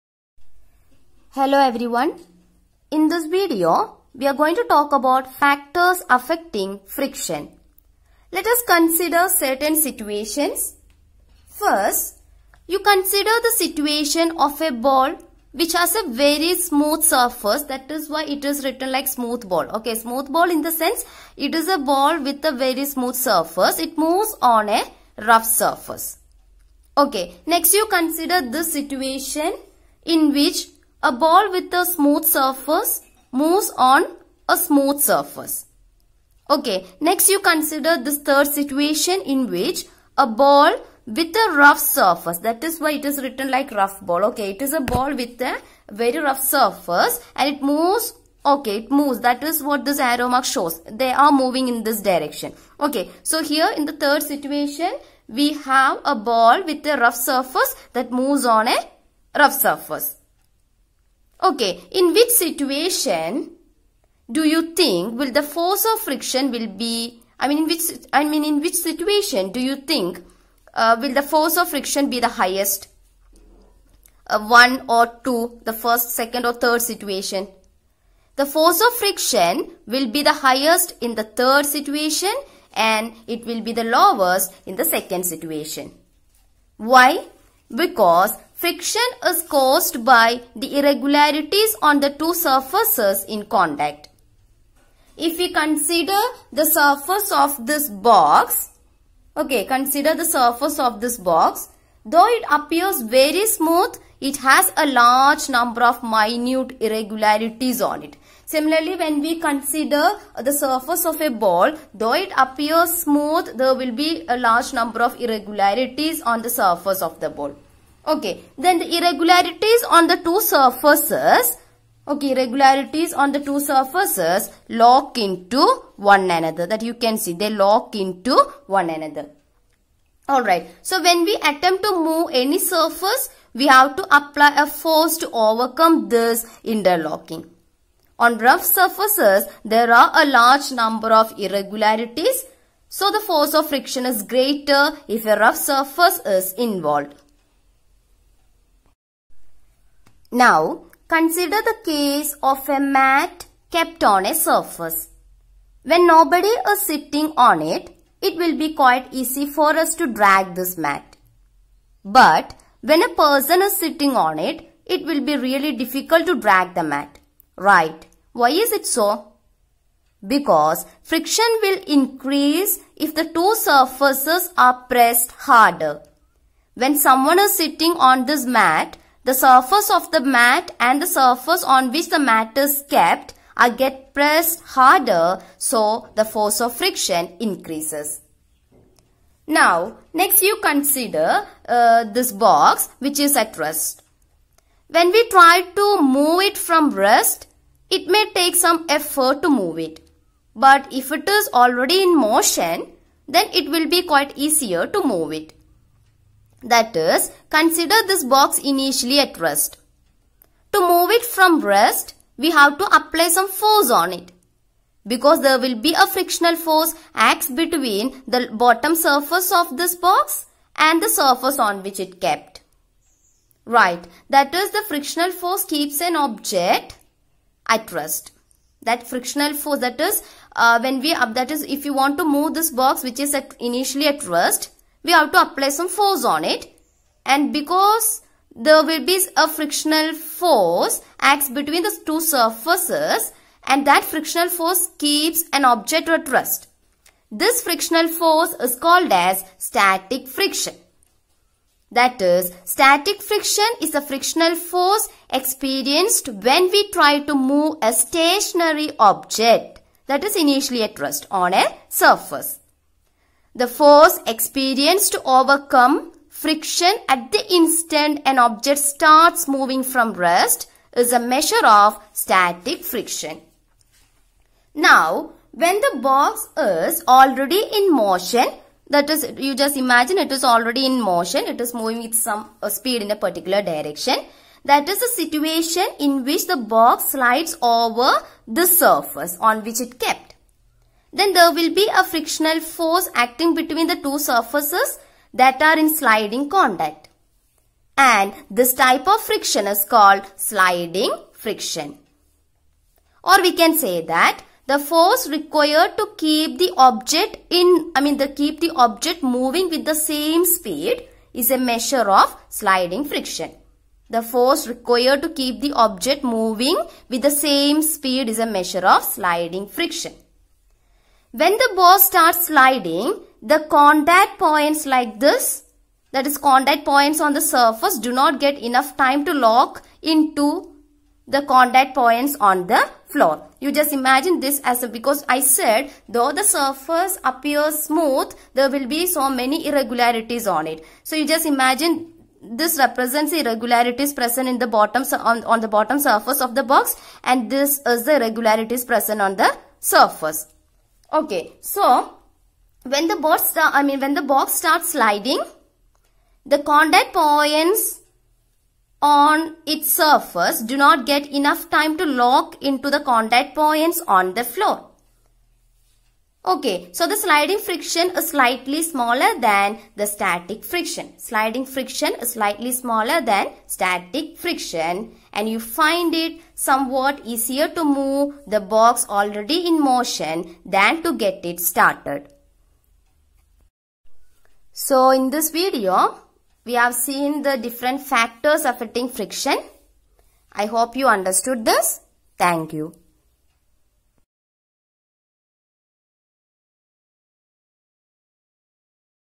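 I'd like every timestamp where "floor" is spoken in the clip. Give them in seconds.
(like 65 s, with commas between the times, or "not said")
333 s, 364 s.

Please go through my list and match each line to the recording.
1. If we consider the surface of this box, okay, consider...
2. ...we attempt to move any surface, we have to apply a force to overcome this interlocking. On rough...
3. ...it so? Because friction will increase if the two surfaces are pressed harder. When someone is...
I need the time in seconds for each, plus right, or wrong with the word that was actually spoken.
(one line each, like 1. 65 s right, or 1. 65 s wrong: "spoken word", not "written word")
1. 95 s right
2. 131 s right
3. 168 s right.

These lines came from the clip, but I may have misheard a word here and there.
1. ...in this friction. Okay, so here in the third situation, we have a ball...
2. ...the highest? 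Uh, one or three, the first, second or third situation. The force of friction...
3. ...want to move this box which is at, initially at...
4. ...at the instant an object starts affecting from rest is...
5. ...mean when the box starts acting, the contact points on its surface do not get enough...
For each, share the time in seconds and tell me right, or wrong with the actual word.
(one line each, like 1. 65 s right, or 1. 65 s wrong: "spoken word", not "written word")
1. 51 s wrong: "direction", not "friction"
2. 72 s wrong: "two", not "three"
3. 231 s right
4. 267 s wrong: "moving", not "affecting"
5. 353 s wrong: "sliding", not "acting".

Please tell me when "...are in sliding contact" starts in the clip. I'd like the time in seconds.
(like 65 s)
295 s.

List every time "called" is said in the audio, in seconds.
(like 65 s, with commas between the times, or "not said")
248 s, 299 s.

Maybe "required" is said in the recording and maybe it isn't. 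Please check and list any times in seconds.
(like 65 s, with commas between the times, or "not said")
305 s, 314 s.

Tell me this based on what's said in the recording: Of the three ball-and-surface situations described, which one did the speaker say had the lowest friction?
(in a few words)
Second situation.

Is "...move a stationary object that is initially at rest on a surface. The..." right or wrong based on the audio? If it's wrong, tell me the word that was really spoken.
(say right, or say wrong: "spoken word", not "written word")
right.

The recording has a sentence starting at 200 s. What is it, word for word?
But if it is already in motion, then it will be quite easier to move it.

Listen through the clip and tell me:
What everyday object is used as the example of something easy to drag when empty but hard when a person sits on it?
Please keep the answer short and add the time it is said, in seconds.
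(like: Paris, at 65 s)
A mat, at 152 s.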